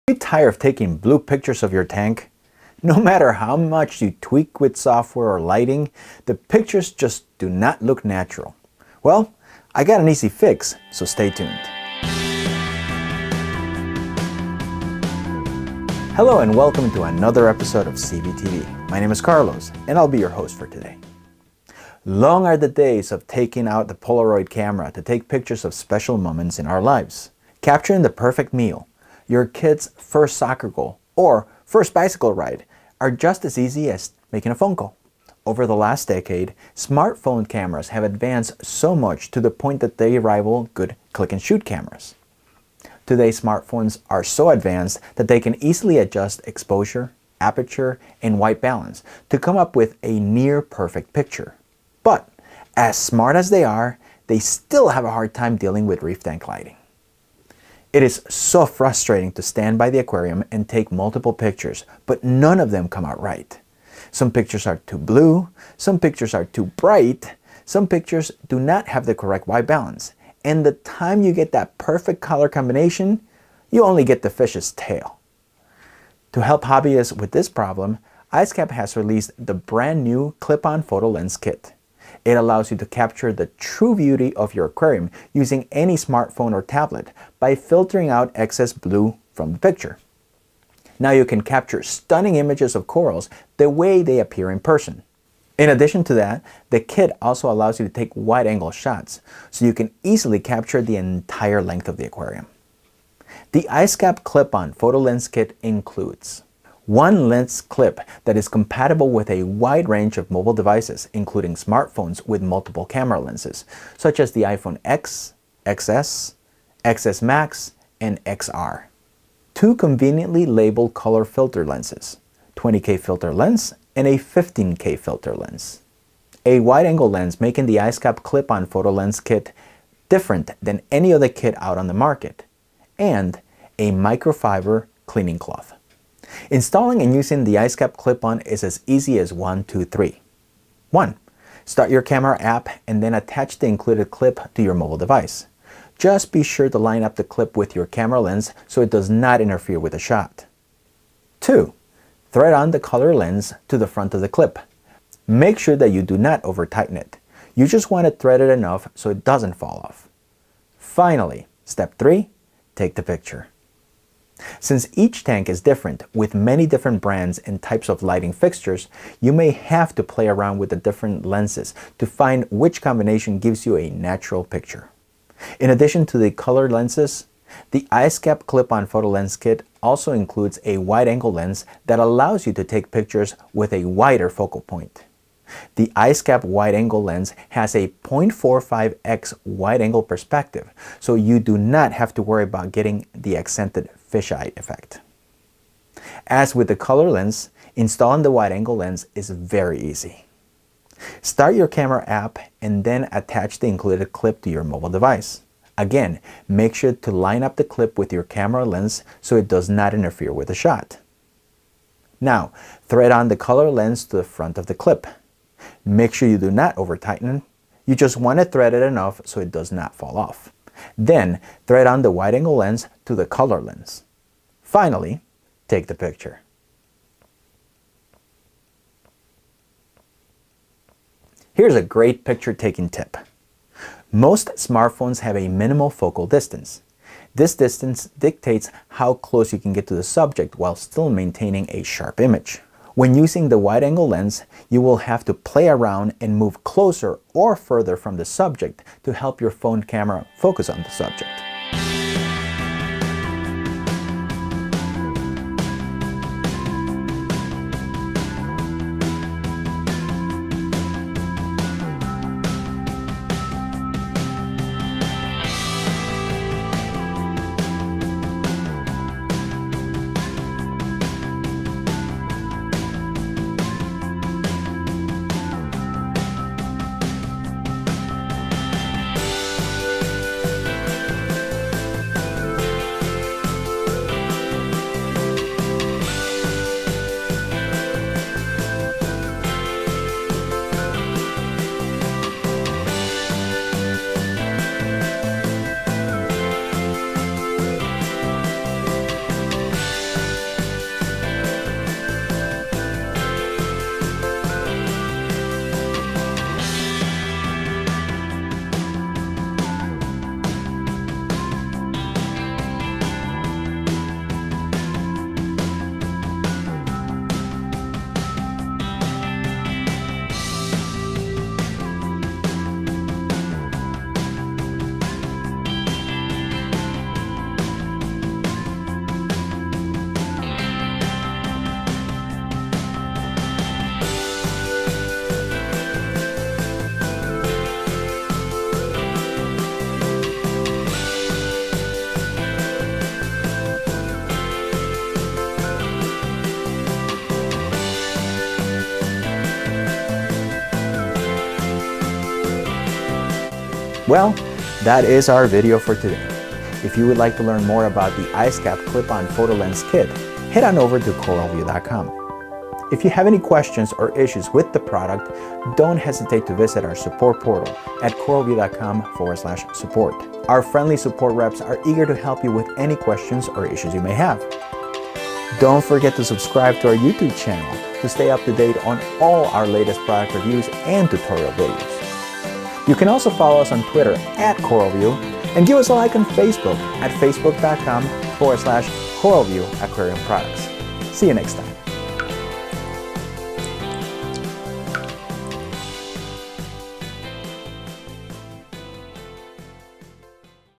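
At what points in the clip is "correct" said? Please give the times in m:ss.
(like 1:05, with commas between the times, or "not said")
1:09.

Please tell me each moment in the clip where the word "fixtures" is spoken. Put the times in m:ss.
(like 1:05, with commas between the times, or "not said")
2:48.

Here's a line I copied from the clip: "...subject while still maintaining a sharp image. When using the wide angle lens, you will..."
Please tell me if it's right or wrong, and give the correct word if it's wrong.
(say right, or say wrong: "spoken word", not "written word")
right.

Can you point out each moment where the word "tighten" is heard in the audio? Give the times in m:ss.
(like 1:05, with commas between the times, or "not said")
2:36, 3:36.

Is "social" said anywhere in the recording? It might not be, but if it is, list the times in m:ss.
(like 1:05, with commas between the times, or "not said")
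not said.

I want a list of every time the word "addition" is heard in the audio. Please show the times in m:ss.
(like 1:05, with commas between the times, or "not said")
1:35, 2:55.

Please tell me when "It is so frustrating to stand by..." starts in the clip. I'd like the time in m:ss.
0:57.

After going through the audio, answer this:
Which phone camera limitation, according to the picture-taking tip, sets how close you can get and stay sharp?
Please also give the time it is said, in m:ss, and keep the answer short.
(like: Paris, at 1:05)
minimal focal distance, at 3:55.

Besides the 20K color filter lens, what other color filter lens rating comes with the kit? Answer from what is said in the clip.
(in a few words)
15K.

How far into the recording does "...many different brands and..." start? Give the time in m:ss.
2:46.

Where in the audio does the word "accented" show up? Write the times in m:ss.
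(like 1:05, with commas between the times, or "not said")
3:13.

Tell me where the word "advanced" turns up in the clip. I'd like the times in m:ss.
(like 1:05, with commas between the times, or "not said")
0:38, 0:44.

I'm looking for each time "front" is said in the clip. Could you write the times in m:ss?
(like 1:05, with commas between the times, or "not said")
2:33, 3:34.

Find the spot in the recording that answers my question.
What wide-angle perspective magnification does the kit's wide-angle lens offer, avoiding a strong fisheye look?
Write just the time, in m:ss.
3:08.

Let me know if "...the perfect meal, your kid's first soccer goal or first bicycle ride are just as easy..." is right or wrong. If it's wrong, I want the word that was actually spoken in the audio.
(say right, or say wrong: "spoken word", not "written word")
right.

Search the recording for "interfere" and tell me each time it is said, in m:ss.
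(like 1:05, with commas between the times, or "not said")
2:29, 3:29.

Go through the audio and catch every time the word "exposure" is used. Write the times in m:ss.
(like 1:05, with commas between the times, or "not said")
0:46.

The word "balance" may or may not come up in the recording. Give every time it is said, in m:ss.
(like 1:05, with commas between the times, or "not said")
0:48, 1:09.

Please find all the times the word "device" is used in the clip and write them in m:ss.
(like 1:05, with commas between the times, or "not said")
1:50, 2:24, 3:24.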